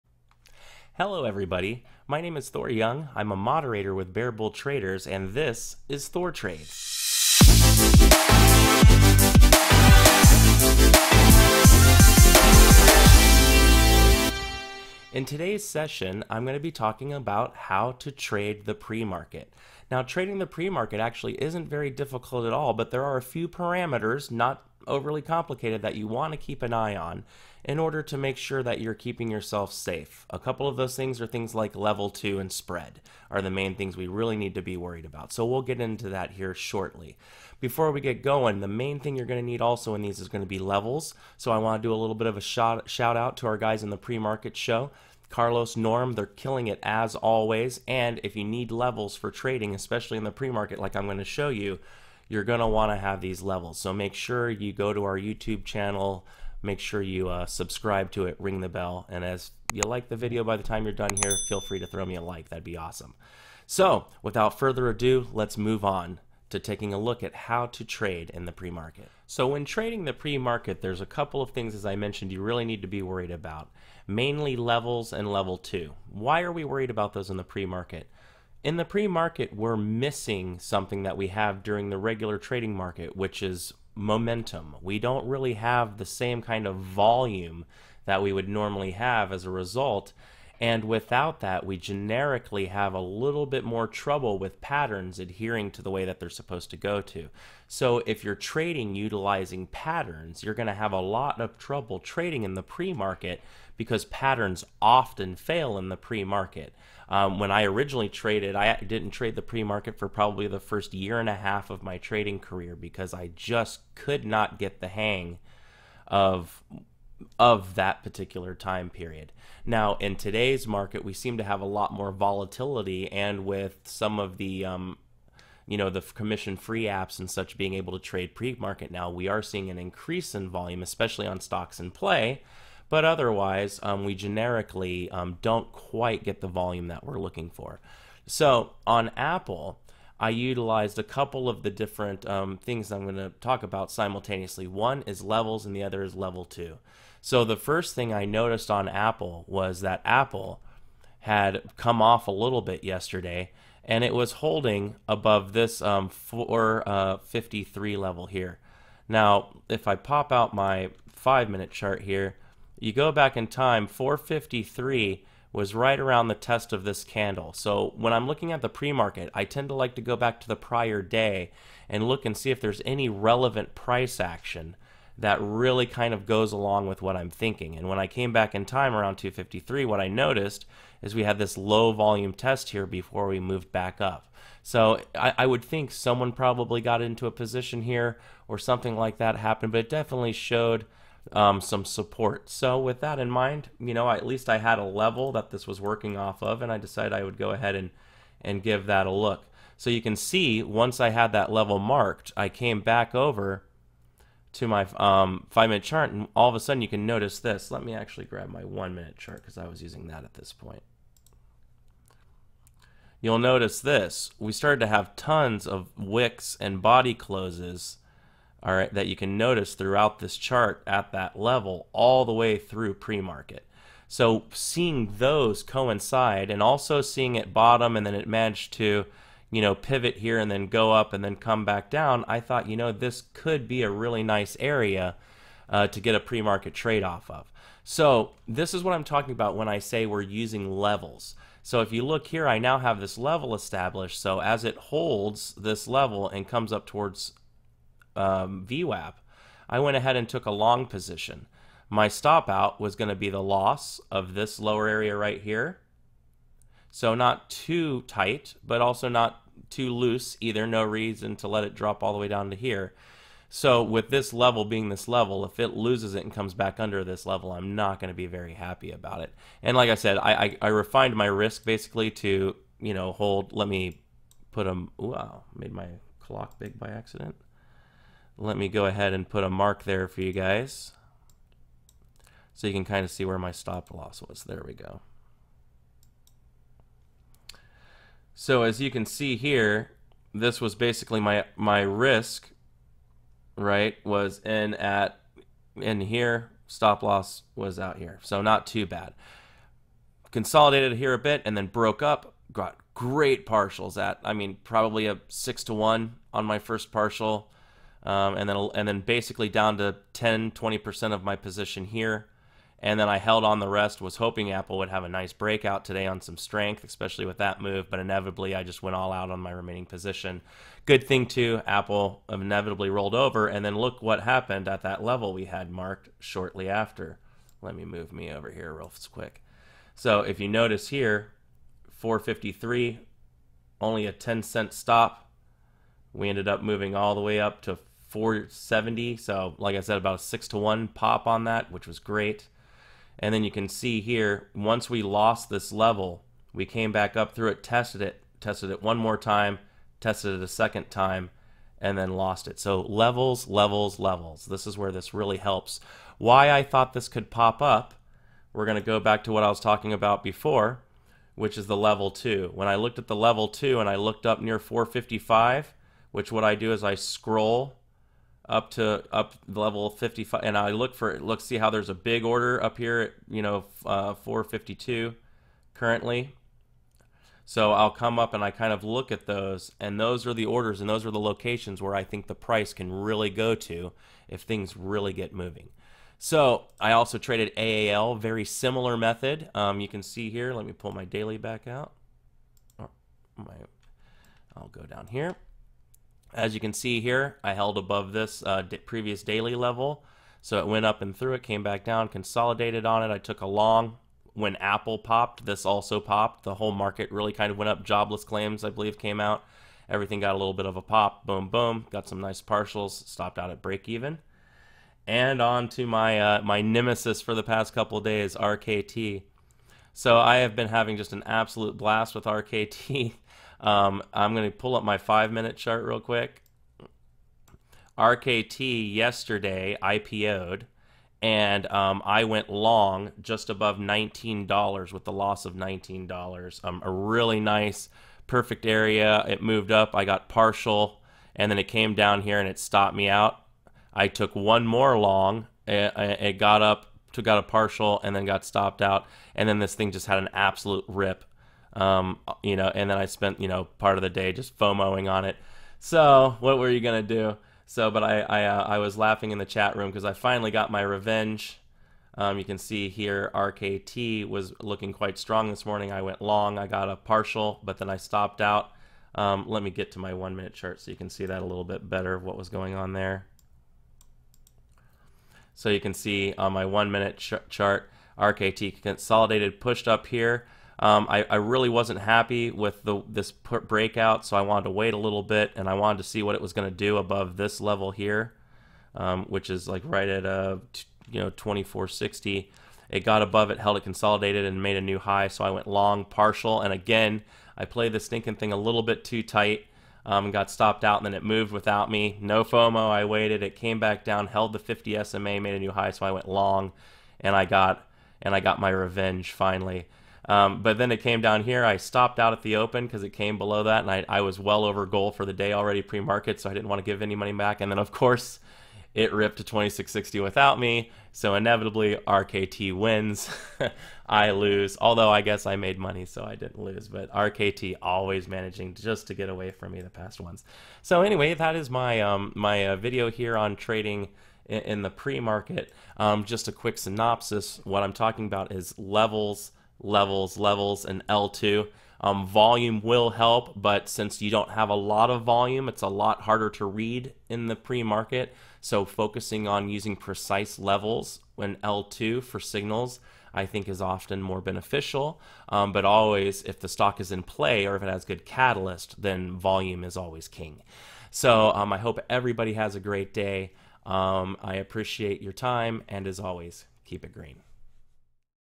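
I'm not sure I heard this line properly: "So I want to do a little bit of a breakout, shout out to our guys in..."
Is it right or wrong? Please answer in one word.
wrong.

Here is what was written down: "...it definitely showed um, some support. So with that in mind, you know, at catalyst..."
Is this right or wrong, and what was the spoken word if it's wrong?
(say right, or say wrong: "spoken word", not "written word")
wrong: "least", not "catalyst".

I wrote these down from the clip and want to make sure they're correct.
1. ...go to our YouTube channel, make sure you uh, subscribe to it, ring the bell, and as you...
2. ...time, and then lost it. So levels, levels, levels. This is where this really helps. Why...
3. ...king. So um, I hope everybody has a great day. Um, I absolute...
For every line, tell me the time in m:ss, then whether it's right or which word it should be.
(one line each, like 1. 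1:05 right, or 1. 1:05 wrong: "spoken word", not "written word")
1. 0:54 right
2. 5:50 right
3. 9:20 wrong: "appreciate", not "absolute".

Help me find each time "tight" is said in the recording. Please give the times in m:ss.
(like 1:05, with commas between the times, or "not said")
4:18, 8:19.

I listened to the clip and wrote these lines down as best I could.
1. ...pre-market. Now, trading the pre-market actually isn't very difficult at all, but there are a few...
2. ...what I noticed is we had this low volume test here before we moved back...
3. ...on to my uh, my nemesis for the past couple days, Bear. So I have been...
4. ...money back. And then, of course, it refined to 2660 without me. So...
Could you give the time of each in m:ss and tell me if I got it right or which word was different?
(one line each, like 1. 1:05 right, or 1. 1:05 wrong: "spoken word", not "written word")
1. 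0:18 right
2. 2:59 right
3. 6:55 wrong: "RKT", not "Bear"
4. 8:37 wrong: "ripped", not "refined".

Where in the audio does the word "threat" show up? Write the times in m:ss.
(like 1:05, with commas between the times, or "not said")
not said.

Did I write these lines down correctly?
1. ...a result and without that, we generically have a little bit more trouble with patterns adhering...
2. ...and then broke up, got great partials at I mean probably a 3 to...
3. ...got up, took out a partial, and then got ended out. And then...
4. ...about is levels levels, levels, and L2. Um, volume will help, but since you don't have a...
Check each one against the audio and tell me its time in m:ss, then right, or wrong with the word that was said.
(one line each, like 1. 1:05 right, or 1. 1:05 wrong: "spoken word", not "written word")
1. 1:29 right
2. 5:01 wrong: "6", not "3"
3. 7:26 wrong: "stopped", not "ended"
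4. 8:58 right.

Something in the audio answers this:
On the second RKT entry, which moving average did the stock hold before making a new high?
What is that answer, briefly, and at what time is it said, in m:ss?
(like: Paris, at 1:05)
50 SMA, at 8:24.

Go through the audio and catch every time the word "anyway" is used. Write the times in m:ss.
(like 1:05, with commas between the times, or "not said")
8:51.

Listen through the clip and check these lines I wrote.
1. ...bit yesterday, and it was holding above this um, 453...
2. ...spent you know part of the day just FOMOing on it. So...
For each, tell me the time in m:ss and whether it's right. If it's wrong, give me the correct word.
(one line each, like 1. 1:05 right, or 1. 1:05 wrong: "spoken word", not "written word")
1. 2:32 right
2. 7:33 right.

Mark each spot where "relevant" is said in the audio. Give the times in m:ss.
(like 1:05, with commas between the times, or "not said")
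2:53.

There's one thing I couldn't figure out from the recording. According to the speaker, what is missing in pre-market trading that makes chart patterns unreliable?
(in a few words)
Momentum.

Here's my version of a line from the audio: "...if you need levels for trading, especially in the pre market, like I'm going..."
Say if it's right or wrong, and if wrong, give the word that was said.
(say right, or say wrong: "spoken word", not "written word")
right.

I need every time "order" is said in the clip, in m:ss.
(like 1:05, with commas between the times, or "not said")
0:27, 6:12, 6:20.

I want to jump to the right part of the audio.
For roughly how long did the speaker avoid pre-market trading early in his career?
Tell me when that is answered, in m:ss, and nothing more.
1:50.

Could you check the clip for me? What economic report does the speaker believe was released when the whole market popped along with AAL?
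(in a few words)
Jobless claims.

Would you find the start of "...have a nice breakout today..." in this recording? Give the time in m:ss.
5:14.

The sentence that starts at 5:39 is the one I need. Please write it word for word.
So, like I said, about a six to one pop on that, which was great.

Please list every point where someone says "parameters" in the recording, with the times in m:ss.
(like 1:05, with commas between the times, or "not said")
0:23.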